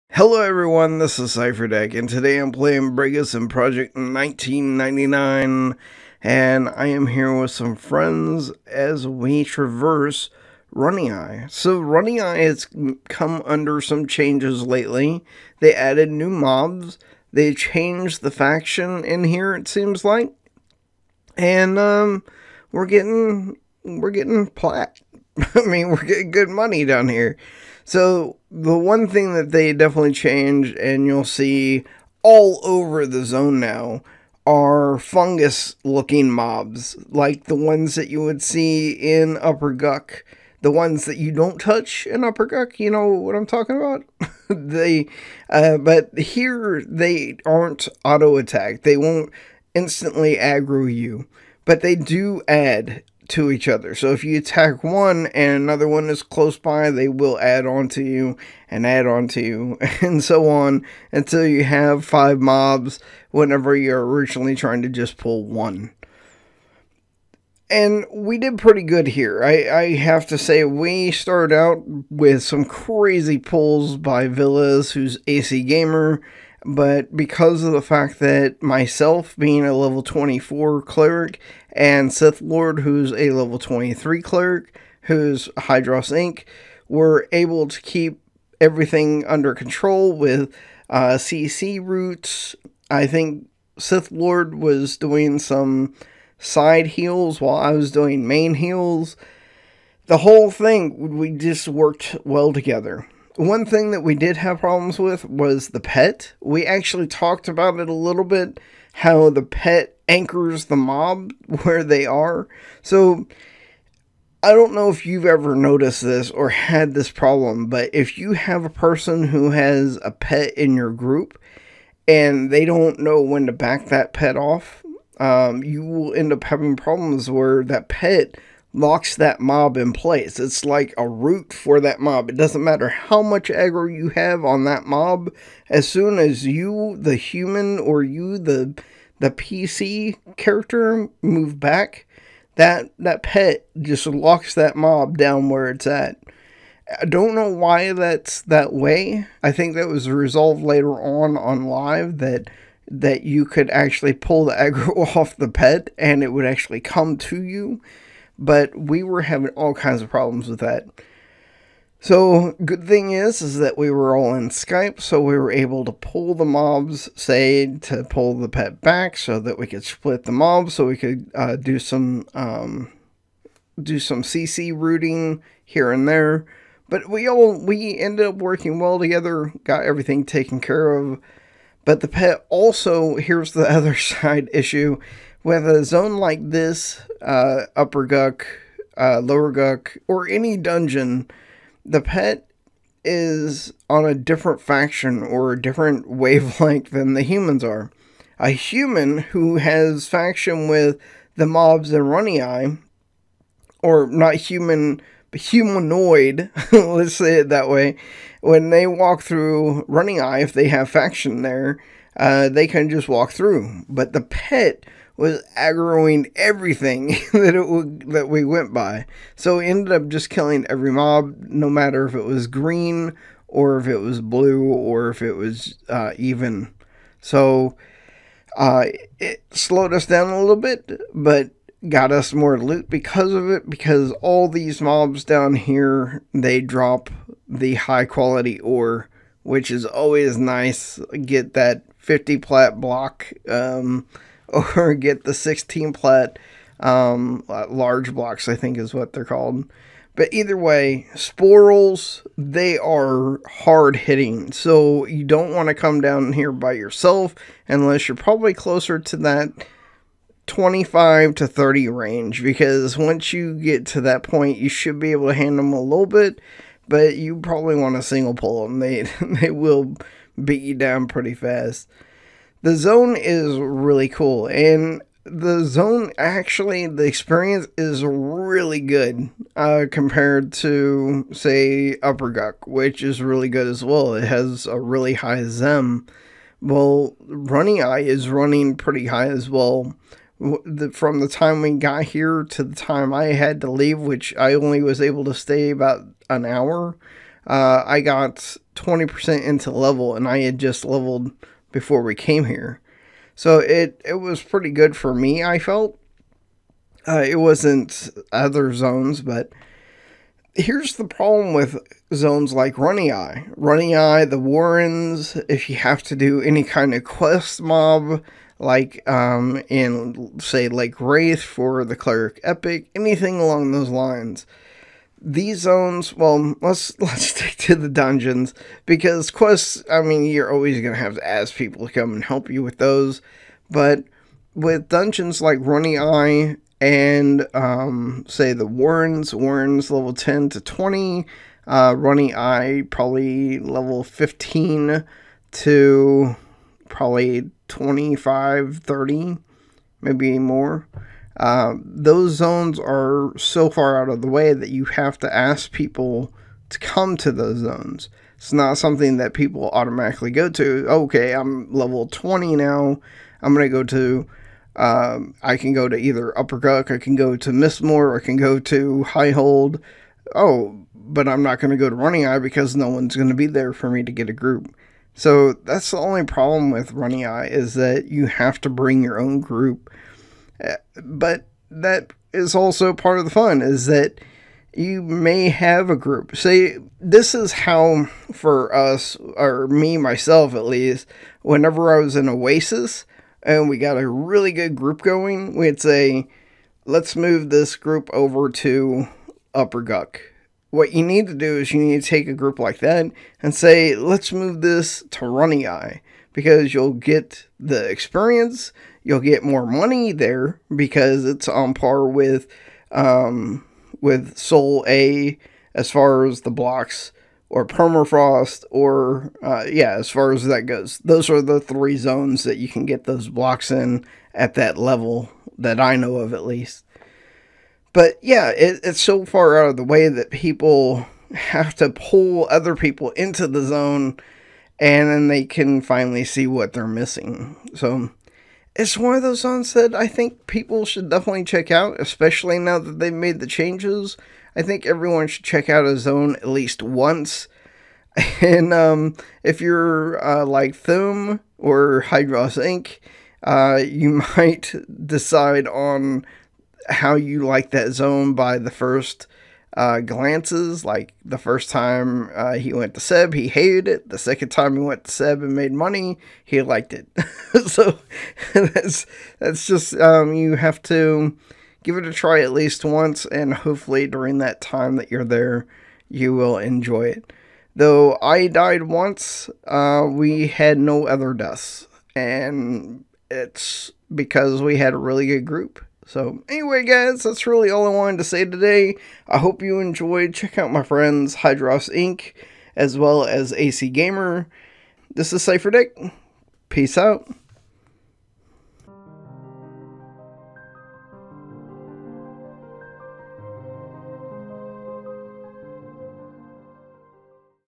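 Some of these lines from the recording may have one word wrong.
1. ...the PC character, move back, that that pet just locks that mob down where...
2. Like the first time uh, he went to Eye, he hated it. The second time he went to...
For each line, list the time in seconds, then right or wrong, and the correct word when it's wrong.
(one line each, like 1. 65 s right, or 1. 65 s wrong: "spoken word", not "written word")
1. 139 s right
2. 460 s wrong: "Seb", not "Eye".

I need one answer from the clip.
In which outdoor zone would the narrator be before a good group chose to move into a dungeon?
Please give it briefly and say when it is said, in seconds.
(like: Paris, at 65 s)
Oasis, at 392 s.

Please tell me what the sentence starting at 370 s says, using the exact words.
Oh, but I'm not going to go to Runnyeye because no one's going to be there for me to get a group.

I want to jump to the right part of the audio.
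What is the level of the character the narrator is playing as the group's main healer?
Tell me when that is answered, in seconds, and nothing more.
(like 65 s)
79 s.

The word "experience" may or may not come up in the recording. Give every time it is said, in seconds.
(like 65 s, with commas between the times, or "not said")
277 s, 407 s.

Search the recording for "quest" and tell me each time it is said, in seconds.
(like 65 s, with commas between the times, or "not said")
317 s, 329 s.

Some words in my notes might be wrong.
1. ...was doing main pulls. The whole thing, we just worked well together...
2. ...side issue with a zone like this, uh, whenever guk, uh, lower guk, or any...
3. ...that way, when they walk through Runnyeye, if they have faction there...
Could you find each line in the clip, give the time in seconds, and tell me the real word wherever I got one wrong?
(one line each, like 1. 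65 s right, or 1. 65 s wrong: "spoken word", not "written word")
1. 97 s wrong: "heals", not "pulls"
2. 183 s wrong: "upper", not "whenever"
3. 207 s right.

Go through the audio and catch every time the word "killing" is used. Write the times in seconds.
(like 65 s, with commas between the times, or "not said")
220 s.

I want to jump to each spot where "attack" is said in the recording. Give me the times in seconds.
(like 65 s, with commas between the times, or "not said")
48 s, 54 s.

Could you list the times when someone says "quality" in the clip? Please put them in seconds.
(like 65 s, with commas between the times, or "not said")
238 s.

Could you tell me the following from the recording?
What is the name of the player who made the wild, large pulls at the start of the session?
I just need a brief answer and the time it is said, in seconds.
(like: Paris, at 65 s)
Villas, at 74 s.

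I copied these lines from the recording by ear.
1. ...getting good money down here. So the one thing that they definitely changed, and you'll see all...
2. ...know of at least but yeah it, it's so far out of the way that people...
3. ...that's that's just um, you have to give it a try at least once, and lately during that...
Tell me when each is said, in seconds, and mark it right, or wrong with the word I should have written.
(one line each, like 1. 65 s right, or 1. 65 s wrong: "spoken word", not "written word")
1. 26 s right
2. 425 s right
3. 468 s wrong: "hopefully", not "lately".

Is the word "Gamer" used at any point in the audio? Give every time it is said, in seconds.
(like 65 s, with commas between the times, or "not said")
75 s, 493 s.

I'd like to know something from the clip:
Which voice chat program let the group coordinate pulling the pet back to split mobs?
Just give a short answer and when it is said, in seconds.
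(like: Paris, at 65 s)
Skype, at 164 s.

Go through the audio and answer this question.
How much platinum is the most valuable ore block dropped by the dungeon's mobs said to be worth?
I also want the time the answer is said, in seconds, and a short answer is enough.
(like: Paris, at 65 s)
50 plat, at 241 s.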